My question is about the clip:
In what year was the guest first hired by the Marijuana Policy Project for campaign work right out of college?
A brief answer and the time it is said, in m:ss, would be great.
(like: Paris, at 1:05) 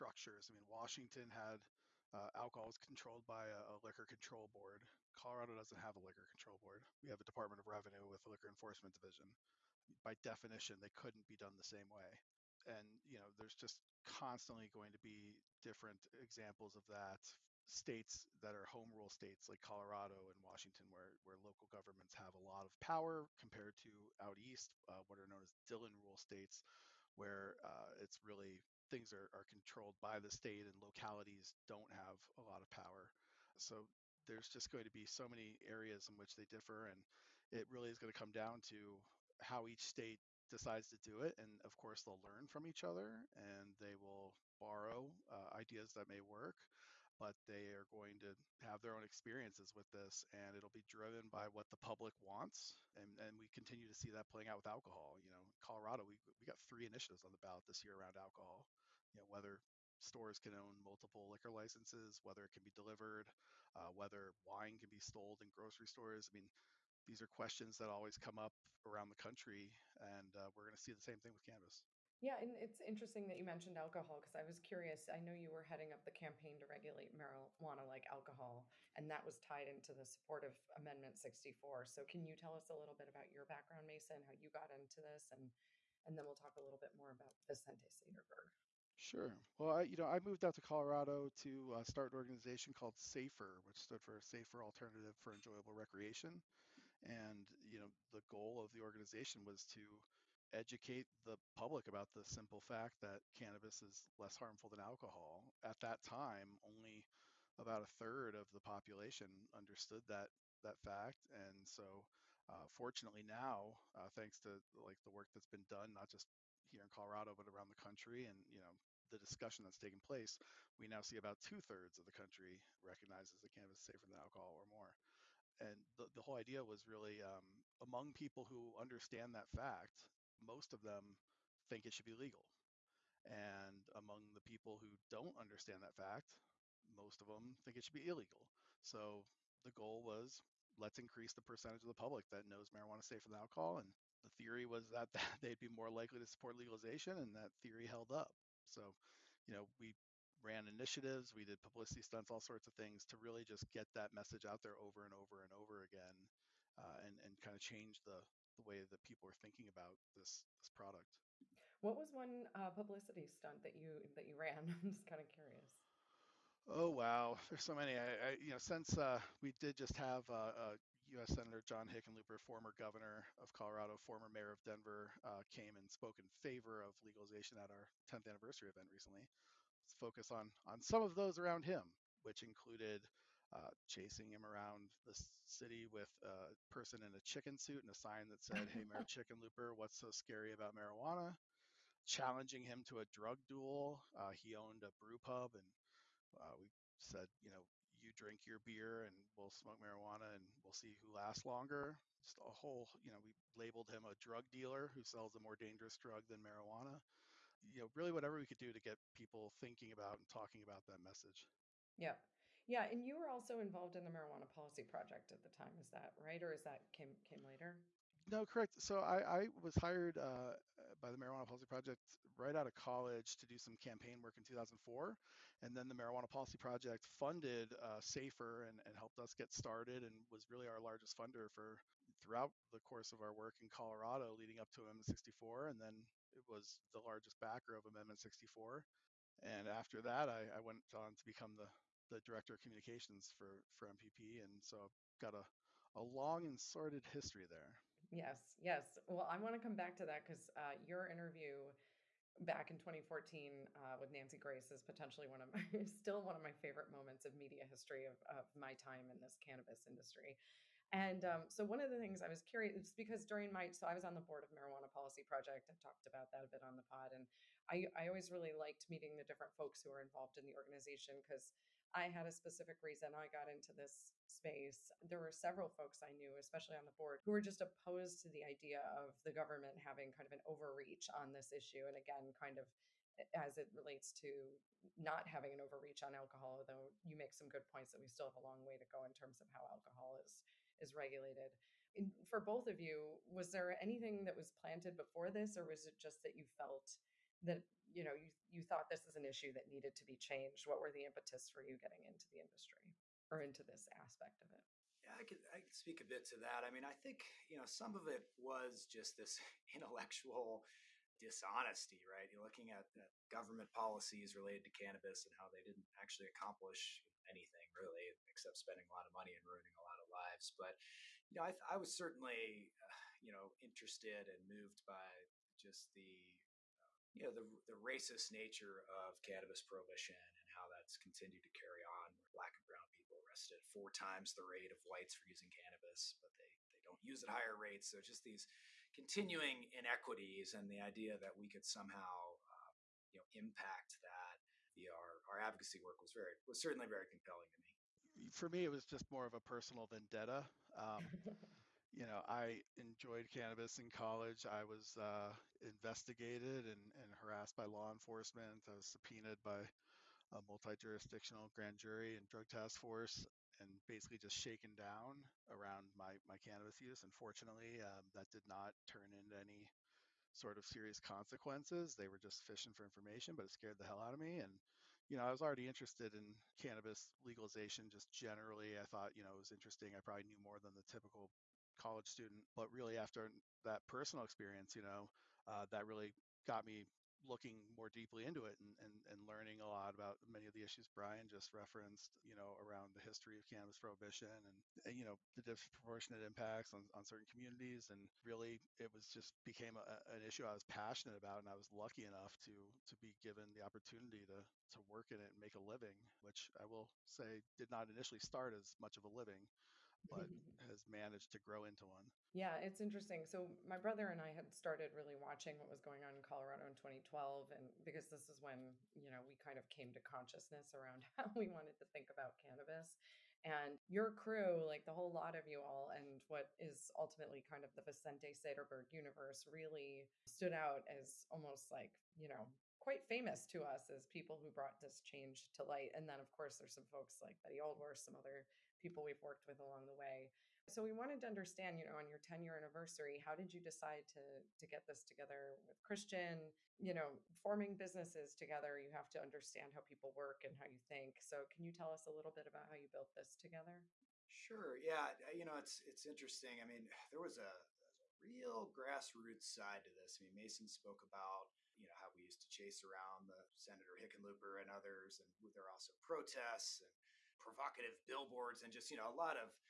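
2004, at 3:44.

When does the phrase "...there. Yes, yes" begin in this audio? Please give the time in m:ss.
4:07.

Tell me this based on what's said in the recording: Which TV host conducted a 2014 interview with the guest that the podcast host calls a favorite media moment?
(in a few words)
Nancy Grace.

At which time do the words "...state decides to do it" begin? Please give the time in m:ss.
0:39.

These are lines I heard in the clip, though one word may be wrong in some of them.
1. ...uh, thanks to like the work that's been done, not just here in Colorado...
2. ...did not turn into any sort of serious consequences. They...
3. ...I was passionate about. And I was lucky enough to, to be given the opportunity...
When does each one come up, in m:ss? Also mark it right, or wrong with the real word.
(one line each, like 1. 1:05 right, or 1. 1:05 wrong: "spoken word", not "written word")
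1. 1:53 right
2. 6:08 right
3. 6:40 right.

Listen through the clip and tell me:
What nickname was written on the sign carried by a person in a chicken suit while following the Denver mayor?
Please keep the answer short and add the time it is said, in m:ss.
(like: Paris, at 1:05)
Mayor Chickenlooper, at 3:08.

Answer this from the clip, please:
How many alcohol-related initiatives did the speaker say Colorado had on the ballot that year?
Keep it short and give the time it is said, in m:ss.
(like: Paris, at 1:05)
3, at 0:56.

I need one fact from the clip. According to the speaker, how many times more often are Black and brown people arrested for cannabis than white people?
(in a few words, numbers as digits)
4 times.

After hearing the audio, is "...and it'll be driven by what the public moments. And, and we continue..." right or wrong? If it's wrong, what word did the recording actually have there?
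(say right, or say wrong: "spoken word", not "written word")
wrong: "wants", not "moments".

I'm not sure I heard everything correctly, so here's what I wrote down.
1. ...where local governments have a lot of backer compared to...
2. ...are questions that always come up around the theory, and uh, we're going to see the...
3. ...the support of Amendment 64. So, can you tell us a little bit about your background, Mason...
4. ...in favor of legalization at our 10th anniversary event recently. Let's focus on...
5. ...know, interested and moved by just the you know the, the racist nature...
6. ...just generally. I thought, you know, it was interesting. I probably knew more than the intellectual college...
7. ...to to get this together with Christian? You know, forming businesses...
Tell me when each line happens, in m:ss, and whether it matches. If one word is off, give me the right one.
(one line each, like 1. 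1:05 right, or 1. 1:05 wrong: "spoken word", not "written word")
1. 0:21 wrong: "power", not "backer"
2. 1:07 wrong: "country", not "theory"
3. 1:19 right
4. 2:56 right
5. 5:23 right
6. 6:17 wrong: "typical", not "intellectual"
7. 7:24 right.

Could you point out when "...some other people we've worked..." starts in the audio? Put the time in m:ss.
7:17.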